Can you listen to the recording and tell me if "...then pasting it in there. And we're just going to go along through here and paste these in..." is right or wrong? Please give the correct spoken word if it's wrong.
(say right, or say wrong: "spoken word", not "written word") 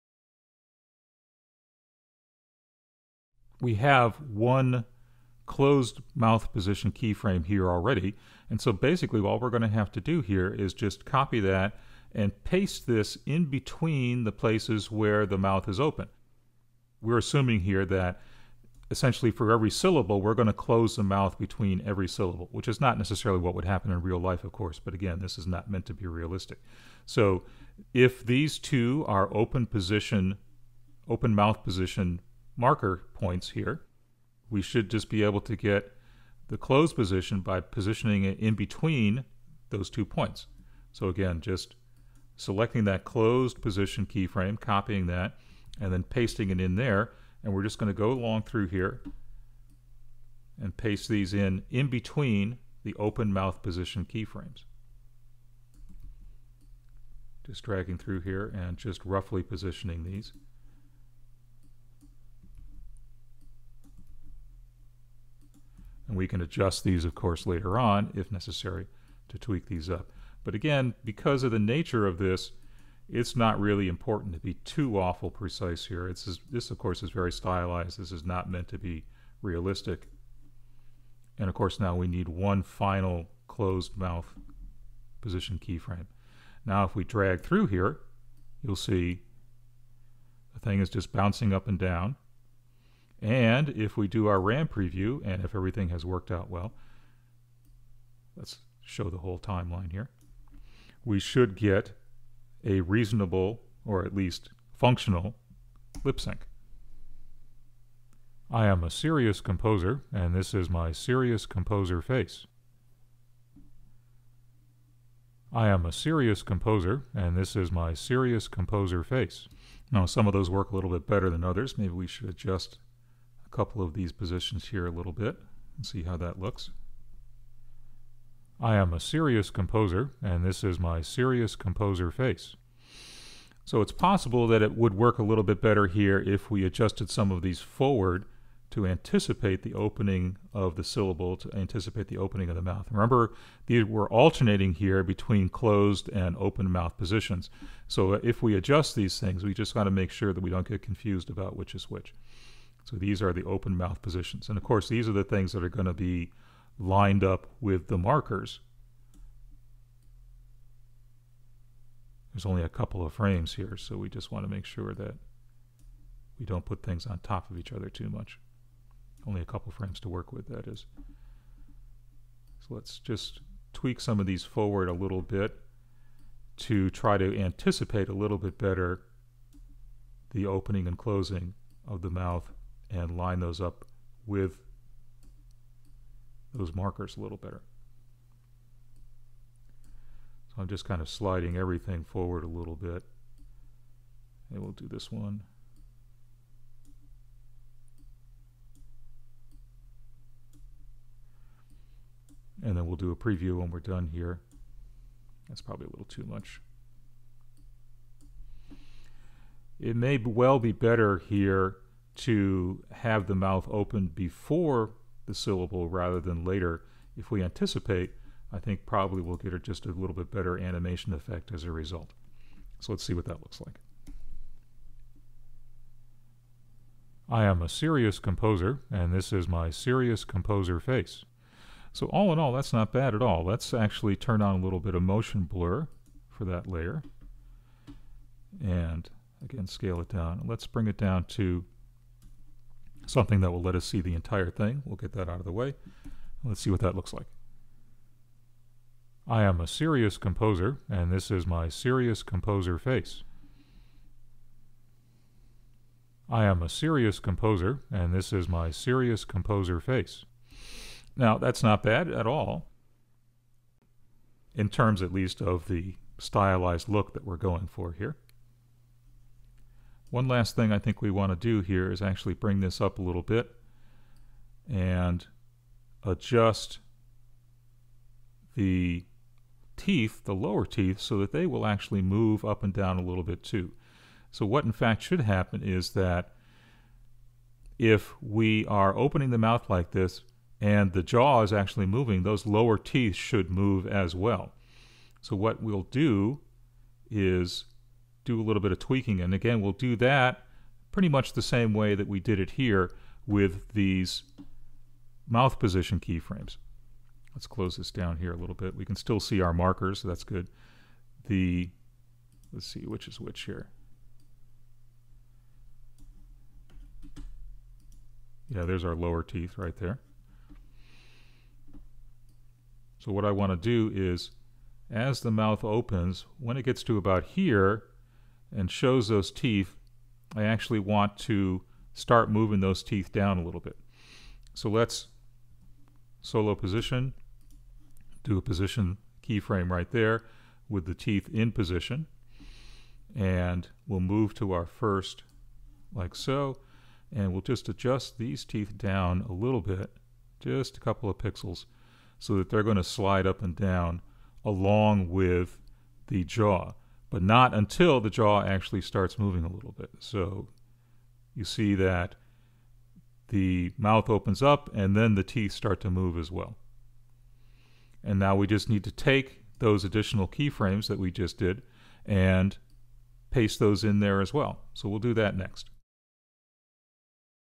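right.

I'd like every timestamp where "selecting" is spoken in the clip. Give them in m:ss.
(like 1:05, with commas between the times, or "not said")
0:42.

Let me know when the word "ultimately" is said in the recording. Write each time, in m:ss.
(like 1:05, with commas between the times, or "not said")
not said.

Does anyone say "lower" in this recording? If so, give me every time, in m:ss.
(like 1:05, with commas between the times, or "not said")
4:40, 4:52, 5:18.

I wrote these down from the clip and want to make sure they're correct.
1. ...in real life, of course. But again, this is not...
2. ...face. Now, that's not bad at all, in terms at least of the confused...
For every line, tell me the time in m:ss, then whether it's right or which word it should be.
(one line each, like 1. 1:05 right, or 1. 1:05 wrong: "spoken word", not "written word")
1. 0:23 right
2. 4:19 wrong: "stylized", not "confused".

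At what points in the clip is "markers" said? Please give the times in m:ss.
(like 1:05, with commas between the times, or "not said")
0:32, 2:37, 3:06, 5:09.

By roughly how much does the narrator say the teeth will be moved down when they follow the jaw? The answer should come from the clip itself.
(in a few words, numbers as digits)
A couple of pixels.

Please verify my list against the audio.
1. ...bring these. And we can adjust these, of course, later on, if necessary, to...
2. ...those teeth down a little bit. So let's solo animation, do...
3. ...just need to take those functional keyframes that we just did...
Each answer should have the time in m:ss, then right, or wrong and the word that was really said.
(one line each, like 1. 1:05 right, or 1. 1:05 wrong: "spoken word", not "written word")
1. 0:59 wrong: "positioning", not "bring"
2. 5:32 wrong: "position", not "animation"
3. 6:08 wrong: "additional", not "functional".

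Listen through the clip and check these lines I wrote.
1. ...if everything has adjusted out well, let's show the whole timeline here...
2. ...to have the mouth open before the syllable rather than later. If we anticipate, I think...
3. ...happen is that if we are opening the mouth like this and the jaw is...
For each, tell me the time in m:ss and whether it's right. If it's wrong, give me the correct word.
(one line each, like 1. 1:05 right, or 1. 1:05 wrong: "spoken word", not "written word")
1. 1:35 wrong: "worked", not "adjusted"
2. 3:32 right
3. 4:45 right.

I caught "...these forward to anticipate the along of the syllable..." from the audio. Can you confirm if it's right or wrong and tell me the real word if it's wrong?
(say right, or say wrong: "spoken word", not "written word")
wrong: "opening", not "along".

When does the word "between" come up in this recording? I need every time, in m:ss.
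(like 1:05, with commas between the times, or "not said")
0:13, 0:21, 0:38, 0:51, 2:25.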